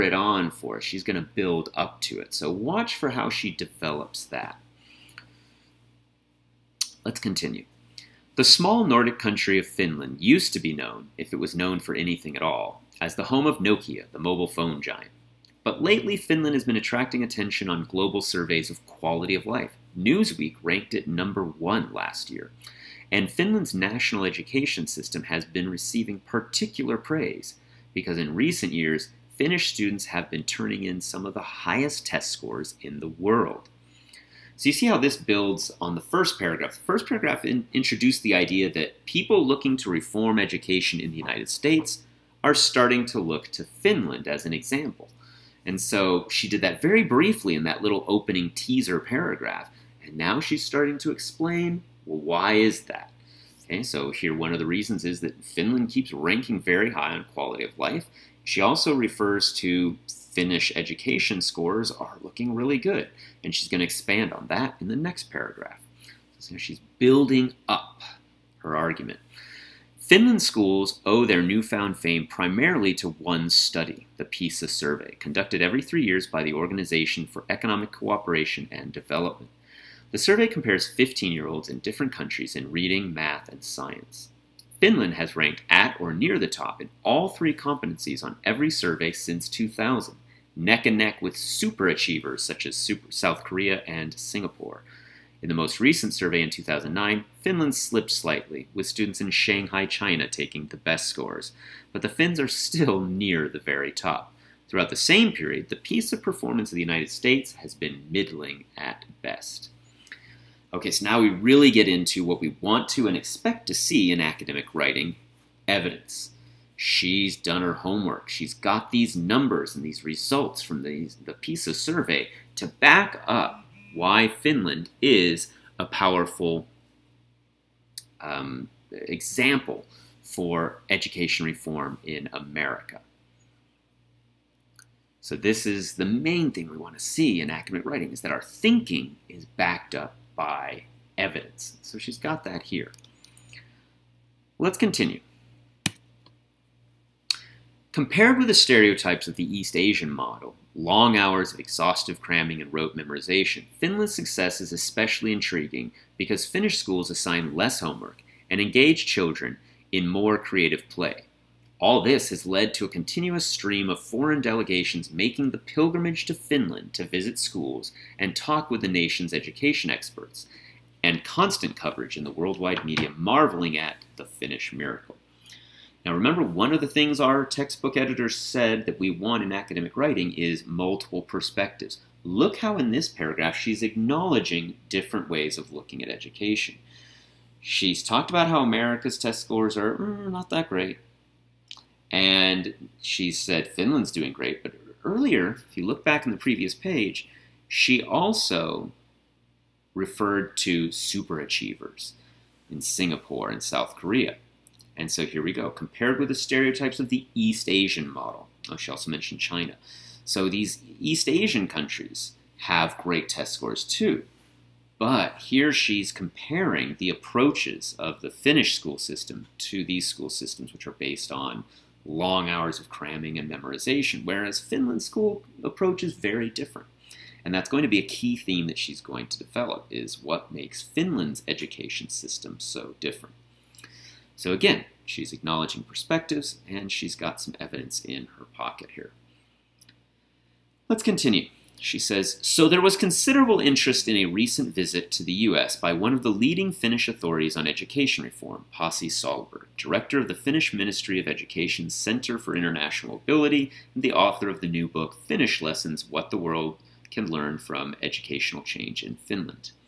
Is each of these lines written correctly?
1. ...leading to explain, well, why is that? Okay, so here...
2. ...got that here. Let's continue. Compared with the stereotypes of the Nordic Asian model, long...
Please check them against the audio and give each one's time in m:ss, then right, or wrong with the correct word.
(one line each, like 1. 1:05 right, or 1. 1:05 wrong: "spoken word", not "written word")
1. 0:50 wrong: "starting", not "leading"
2. 2:22 wrong: "East", not "Nordic".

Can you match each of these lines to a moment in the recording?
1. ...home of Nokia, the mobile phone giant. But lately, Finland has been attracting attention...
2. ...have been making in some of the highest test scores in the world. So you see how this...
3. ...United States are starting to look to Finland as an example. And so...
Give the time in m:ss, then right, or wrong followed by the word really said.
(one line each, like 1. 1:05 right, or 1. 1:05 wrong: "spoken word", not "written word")
1. 0:13 right
2. 0:30 wrong: "turning", not "making"
3. 0:41 right.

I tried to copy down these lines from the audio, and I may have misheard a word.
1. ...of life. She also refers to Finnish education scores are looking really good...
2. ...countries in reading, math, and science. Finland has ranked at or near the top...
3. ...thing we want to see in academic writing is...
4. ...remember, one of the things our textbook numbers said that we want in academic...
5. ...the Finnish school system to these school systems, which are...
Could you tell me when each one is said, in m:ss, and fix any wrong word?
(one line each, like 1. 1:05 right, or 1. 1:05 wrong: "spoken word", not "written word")
1. 0:57 right
2. 1:22 right
3. 2:16 right
4. 2:56 wrong: "editors", not "numbers"
5. 3:38 right.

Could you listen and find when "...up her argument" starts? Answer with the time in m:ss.
1:07.